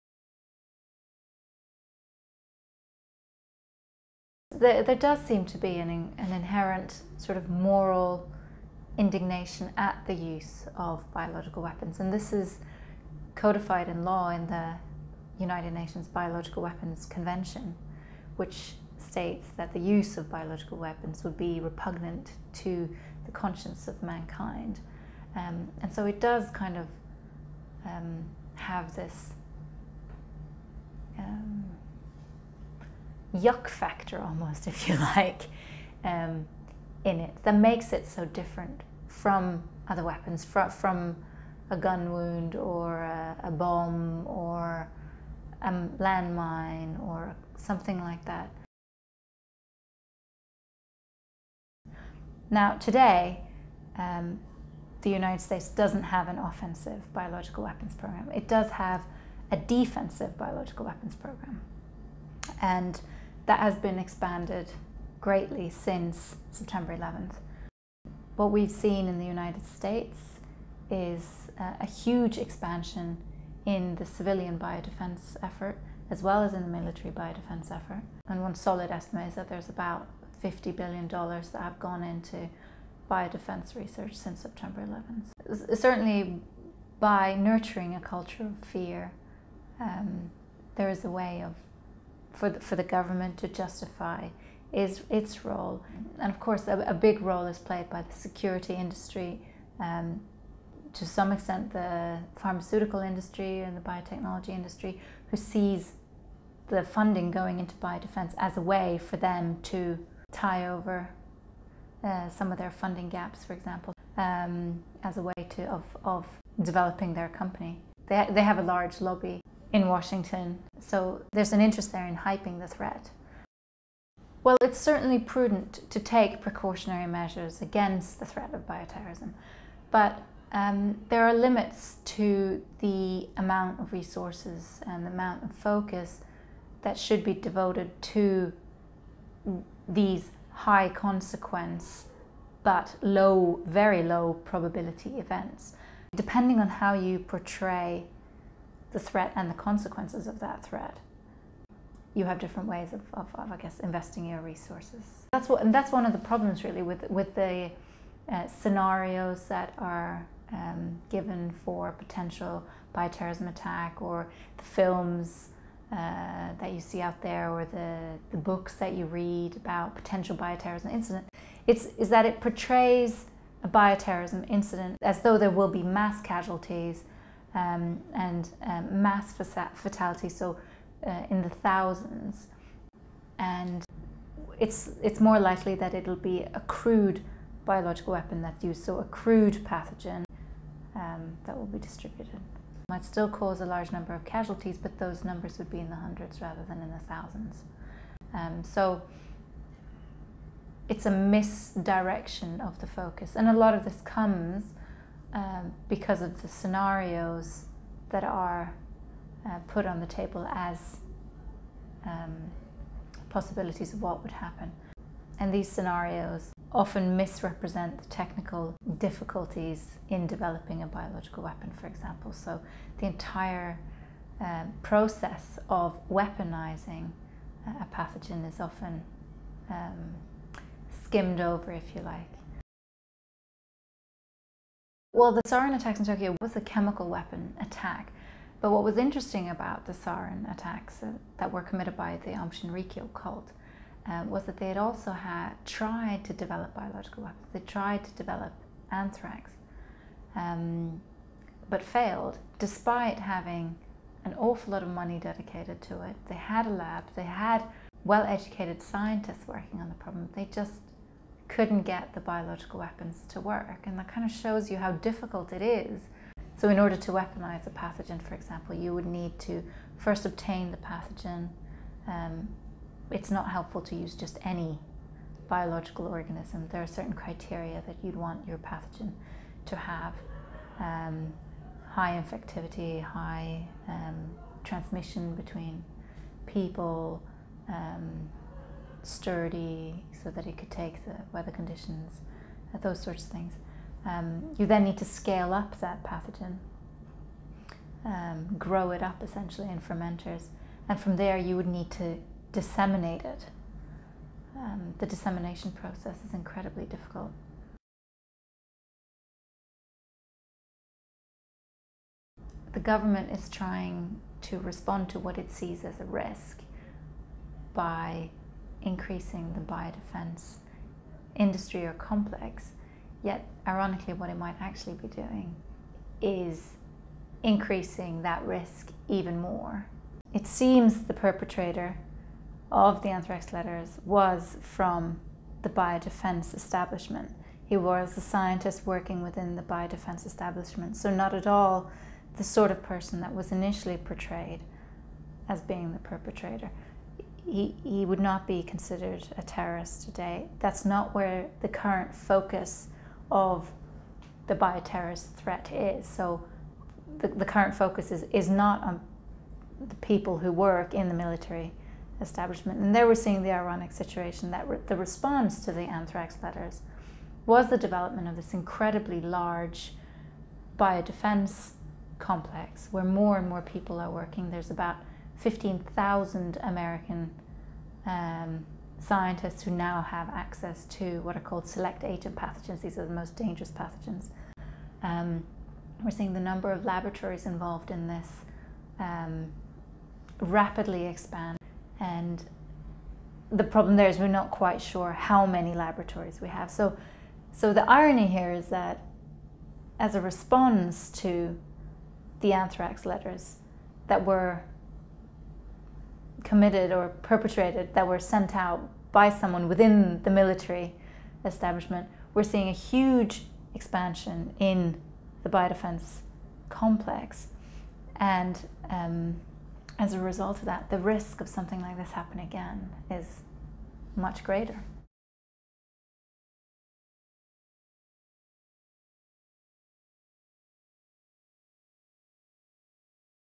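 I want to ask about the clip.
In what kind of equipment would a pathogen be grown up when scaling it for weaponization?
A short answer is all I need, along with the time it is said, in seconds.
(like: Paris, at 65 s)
fermenters, at 299 s.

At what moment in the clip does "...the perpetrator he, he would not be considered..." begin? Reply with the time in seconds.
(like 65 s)
345 s.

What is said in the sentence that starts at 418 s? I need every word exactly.
And um, as a result of that, the risk of something like this happening again is much greater.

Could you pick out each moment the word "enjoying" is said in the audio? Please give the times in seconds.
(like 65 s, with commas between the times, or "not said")
not said.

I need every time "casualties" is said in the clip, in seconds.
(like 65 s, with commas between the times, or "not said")
176 s, 194 s.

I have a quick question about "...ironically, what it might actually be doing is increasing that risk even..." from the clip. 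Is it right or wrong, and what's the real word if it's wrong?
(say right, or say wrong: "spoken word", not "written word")
right.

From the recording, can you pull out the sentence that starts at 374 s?
There's about 15,000 American um, scientists who now have access to what are called select agent pathogens.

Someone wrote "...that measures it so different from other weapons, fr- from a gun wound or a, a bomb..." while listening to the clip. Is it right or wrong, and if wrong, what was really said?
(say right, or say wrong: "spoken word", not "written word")
wrong: "makes", not "measures".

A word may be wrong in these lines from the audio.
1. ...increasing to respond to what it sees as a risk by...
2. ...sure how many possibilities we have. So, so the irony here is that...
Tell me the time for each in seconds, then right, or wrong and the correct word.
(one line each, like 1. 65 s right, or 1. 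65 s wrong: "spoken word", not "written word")
1. 313 s wrong: "trying", not "increasing"
2. 394 s wrong: "laboratories", not "possibilities".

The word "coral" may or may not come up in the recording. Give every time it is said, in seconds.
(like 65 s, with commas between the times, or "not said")
not said.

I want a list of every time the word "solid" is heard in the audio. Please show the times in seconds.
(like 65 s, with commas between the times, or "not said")
78 s.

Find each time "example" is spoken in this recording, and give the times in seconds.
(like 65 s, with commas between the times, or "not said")
113 s, 221 s, 268 s.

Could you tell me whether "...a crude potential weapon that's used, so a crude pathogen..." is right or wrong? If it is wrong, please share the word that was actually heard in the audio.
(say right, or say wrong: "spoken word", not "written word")
wrong: "biological", not "potential".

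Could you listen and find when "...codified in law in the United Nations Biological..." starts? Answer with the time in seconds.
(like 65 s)
13 s.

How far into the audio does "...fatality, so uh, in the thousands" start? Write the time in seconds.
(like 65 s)
179 s.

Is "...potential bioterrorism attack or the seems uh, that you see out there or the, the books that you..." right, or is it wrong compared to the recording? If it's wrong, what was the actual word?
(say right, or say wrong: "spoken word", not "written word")
wrong: "films", not "seems".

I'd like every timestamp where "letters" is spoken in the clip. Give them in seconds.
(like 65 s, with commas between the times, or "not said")
333 s, 366 s, 403 s.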